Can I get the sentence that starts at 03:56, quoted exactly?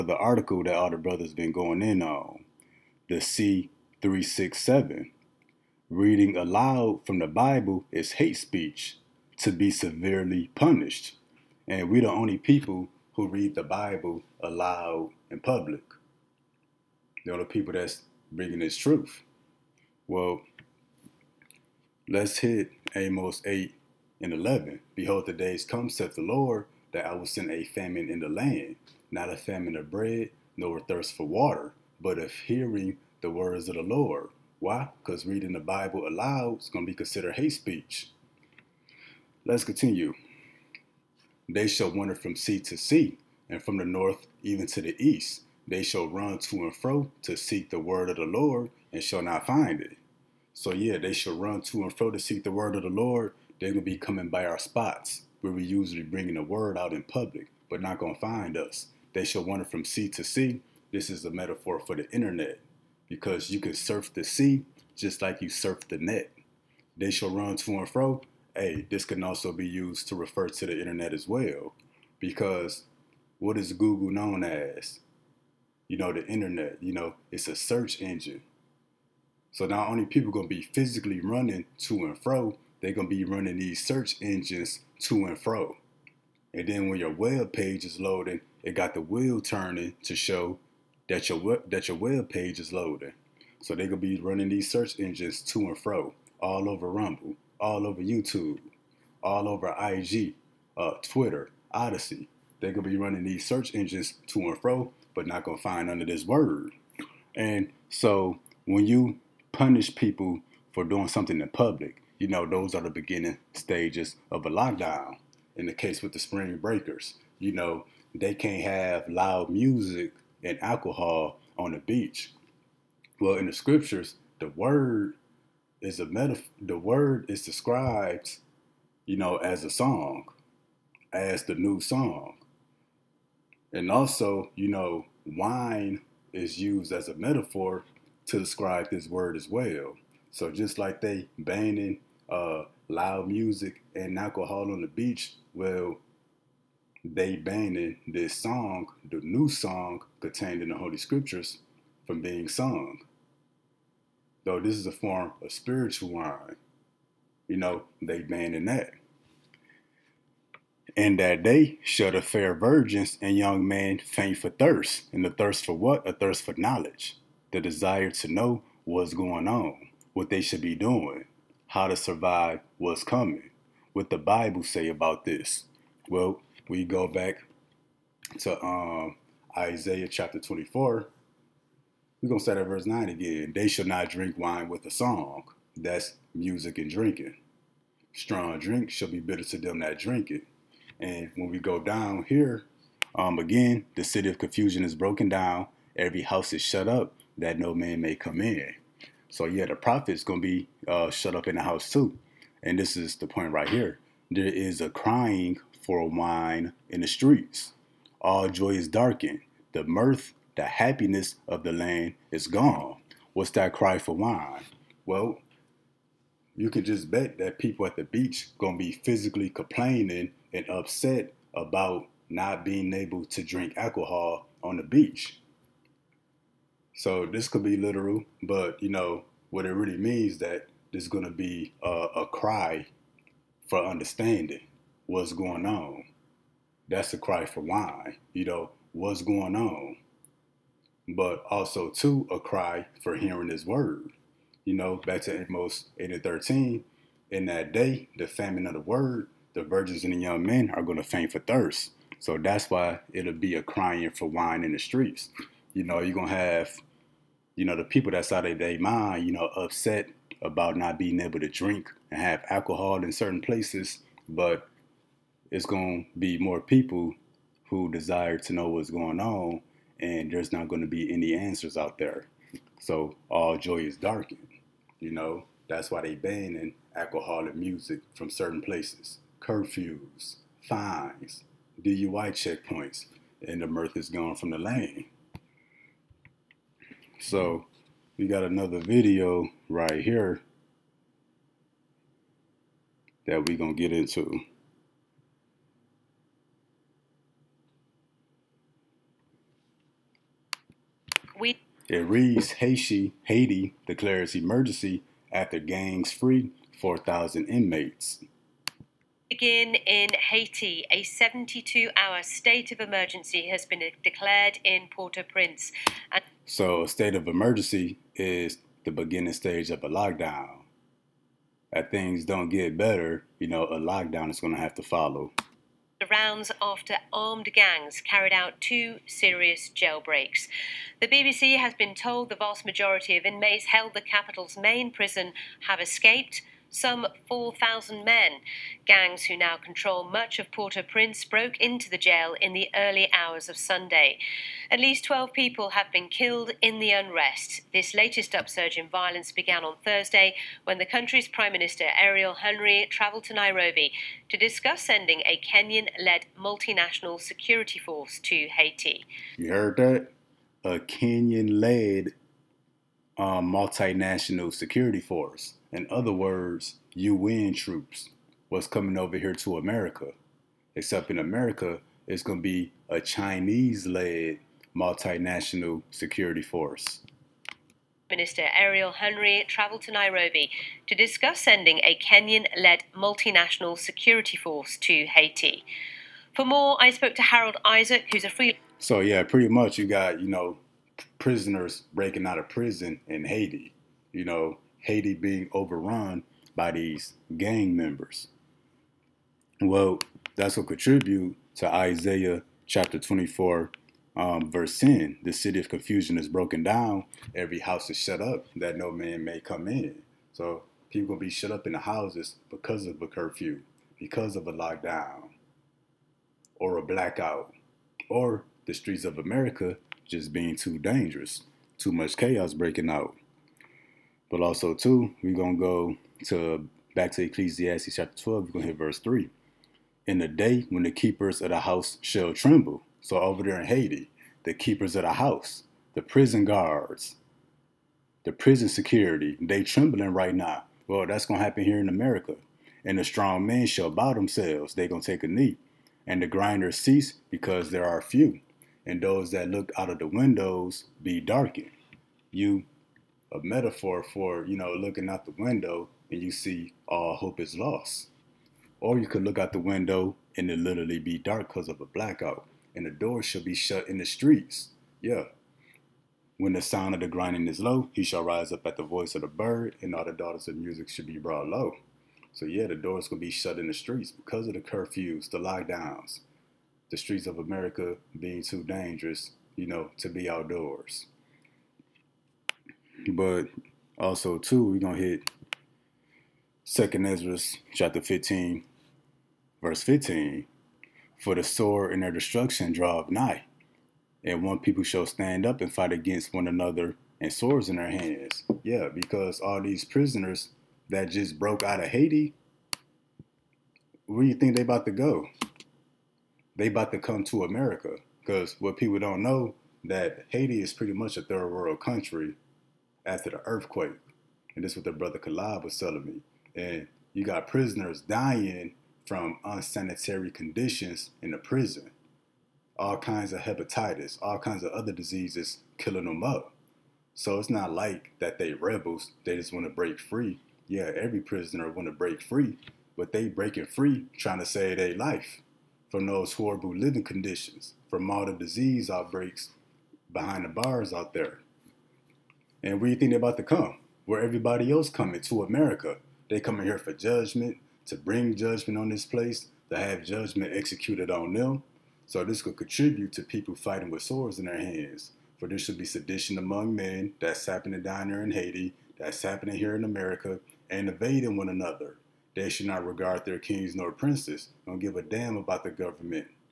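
That's a cry for why, you know, what's going on.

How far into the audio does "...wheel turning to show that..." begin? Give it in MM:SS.
01:29.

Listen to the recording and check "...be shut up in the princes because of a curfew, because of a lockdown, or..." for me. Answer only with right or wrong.
wrong.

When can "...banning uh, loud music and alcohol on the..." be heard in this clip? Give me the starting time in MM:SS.
02:21.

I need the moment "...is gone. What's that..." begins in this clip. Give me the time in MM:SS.
03:32.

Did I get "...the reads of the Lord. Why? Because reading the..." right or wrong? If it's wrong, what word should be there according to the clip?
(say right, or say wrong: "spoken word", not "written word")
wrong: "words", not "reads".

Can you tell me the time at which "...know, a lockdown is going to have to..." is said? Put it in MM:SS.
05:23.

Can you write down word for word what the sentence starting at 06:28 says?
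So, yeah, pretty much you got, you know, prisoners breaking out of prison in Haiti.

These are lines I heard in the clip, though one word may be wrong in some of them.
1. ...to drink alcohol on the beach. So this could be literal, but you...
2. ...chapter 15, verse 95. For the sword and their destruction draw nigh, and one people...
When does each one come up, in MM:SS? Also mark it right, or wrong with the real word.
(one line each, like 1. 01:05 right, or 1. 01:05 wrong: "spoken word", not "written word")
1. 03:43 right
2. 08:07 wrong: "15", not "95".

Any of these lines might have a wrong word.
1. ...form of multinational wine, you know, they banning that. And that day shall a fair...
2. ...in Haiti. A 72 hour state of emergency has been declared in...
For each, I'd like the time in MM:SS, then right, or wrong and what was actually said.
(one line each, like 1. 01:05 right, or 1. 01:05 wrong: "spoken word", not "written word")
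1. 02:34 wrong: "spiritual", not "multinational"
2. 05:09 right.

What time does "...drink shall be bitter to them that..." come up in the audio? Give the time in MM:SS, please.
03:08.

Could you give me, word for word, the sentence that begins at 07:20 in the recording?
Well, that's gonna happen here in America.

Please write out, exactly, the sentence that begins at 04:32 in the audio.
So all joy is darkened, you know.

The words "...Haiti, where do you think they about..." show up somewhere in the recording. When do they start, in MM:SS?
08:21.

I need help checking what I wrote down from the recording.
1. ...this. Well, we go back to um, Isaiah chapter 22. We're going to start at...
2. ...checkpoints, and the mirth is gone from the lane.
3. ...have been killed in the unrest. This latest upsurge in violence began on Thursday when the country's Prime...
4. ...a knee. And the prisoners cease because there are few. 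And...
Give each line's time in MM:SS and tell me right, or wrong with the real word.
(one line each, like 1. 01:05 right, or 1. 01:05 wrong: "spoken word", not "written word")
1. 02:55 wrong: "24", not "22"
2. 04:42 right
3. 05:45 right
4. 07:25 wrong: "grinders", not "prisoners".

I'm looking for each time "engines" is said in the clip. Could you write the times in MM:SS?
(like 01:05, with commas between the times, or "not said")
01:18, 01:24, 01:34, 01:43.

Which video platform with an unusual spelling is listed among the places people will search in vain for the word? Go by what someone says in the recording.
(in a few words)
Odysee.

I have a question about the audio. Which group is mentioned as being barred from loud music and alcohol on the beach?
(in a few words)
spring breakers.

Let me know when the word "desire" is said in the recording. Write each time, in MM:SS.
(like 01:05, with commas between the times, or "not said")
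02:47, 04:27.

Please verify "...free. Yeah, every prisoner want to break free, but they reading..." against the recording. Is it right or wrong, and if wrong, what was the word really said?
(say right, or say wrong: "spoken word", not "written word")
wrong: "breaking", not "reading".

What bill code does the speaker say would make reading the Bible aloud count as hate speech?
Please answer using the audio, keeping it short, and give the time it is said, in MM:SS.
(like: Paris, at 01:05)
C367, at 00:03.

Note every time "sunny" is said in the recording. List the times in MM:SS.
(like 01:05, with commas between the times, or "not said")
not said.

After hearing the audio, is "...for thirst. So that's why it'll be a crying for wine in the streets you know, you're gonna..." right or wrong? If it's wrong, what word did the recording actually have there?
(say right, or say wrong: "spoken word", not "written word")
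right.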